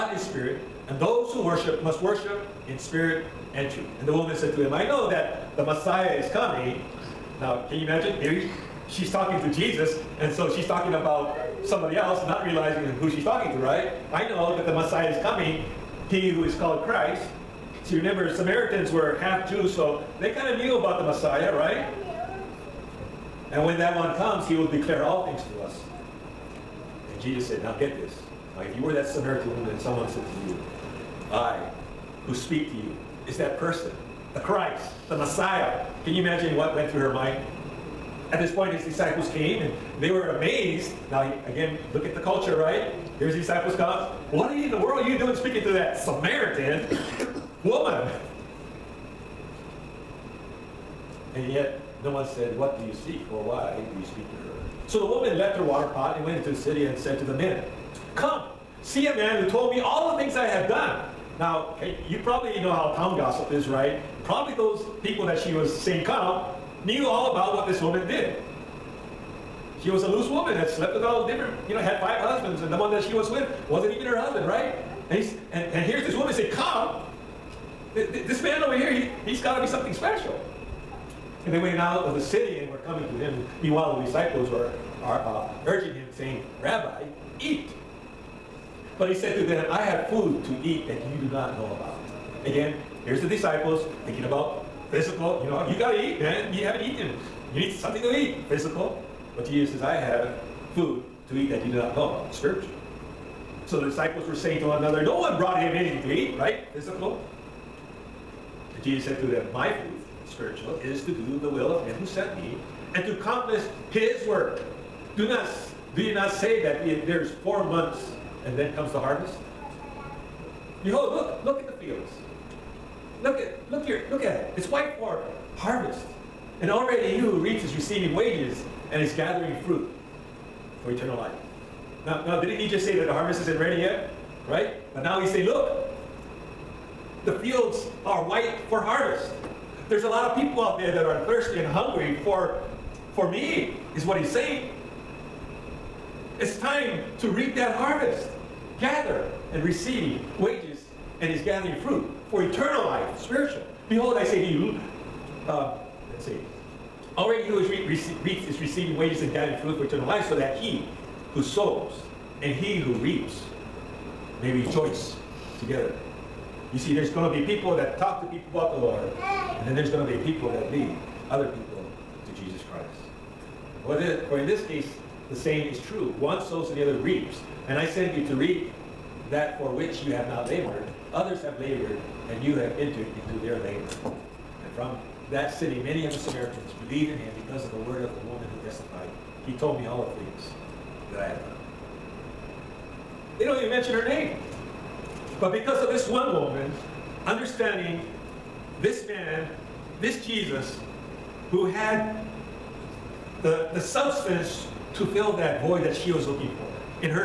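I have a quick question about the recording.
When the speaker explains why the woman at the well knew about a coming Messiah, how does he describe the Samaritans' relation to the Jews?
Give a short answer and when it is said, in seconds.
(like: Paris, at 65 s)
Half Jews, at 19 s.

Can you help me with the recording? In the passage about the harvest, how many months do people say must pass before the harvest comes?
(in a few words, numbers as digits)
4.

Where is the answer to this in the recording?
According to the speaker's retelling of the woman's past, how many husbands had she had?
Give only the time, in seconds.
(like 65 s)
71 s.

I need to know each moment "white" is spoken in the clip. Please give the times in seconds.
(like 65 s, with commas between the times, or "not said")
124 s, 138 s.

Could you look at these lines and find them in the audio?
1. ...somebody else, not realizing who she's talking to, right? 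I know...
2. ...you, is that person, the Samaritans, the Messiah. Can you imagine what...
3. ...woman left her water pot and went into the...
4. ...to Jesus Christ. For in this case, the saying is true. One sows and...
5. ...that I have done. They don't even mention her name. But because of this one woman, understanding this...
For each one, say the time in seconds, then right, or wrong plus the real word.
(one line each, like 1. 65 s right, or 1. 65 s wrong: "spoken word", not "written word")
1. 11 s right
2. 32 s wrong: "Christ", not "Samaritans"
3. 55 s right
4. 172 s right
5. 191 s right.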